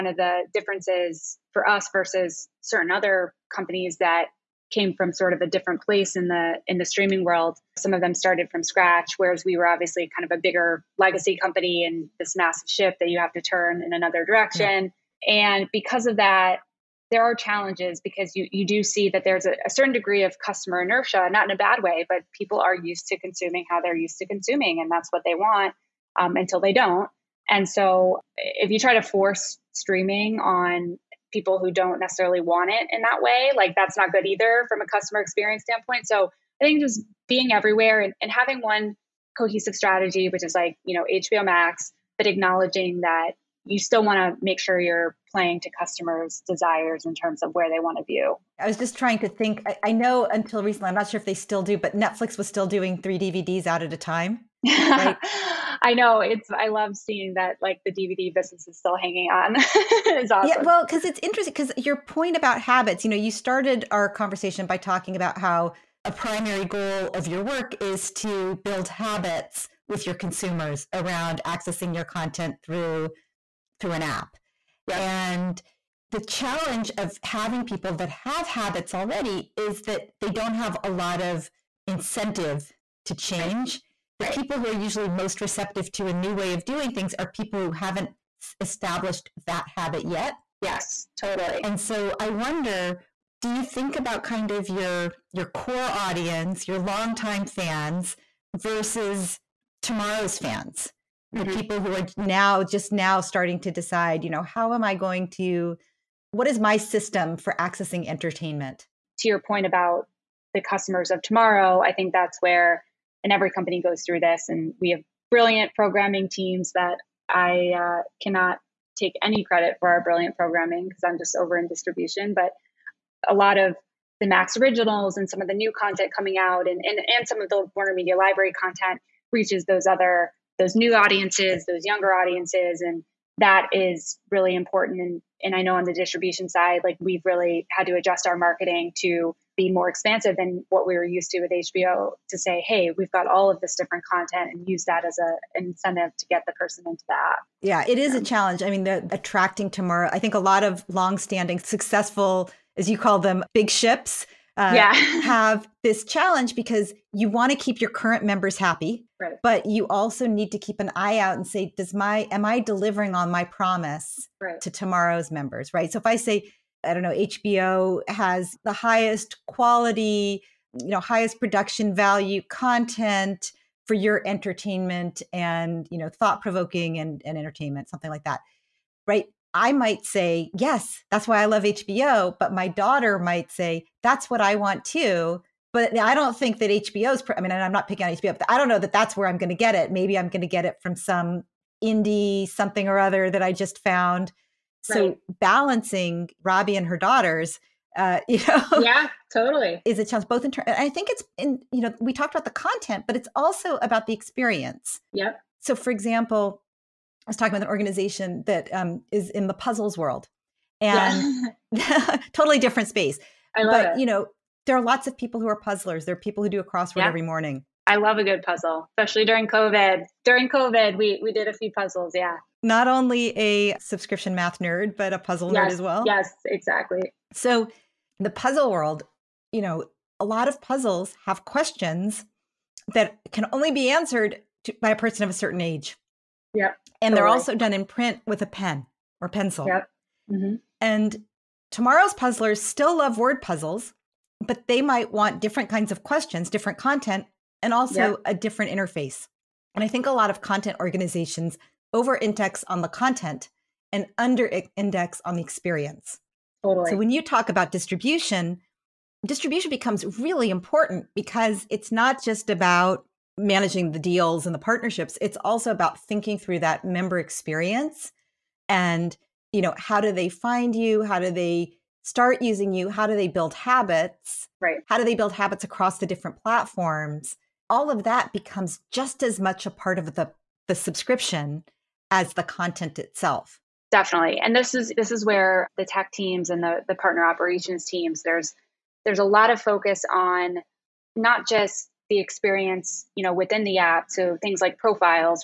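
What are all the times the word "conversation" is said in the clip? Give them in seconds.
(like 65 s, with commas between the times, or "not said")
64 s.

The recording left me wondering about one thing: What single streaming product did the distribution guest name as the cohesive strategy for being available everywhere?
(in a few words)
HBO Max.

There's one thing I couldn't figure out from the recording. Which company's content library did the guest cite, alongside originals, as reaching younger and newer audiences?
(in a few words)
Warner Media Library.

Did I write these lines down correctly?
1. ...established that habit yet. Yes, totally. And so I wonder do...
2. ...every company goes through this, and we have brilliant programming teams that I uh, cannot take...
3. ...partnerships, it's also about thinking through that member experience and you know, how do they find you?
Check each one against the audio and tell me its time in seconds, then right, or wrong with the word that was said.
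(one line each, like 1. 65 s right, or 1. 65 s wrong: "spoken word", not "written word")
1. 88 s right
2. 113 s right
3. 264 s right.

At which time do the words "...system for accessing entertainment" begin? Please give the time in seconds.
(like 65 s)
106 s.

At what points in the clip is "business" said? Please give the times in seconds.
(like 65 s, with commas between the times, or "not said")
58 s.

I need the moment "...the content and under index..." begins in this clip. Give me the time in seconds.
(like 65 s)
252 s.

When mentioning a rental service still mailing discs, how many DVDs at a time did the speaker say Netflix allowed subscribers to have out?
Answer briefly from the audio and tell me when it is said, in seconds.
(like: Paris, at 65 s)
3, at 53 s.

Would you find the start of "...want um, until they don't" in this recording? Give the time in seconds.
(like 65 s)
25 s.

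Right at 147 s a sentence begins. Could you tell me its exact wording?
Yeah, it is a um, challenge.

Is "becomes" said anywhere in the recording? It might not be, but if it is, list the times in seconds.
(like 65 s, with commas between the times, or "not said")
259 s, 278 s.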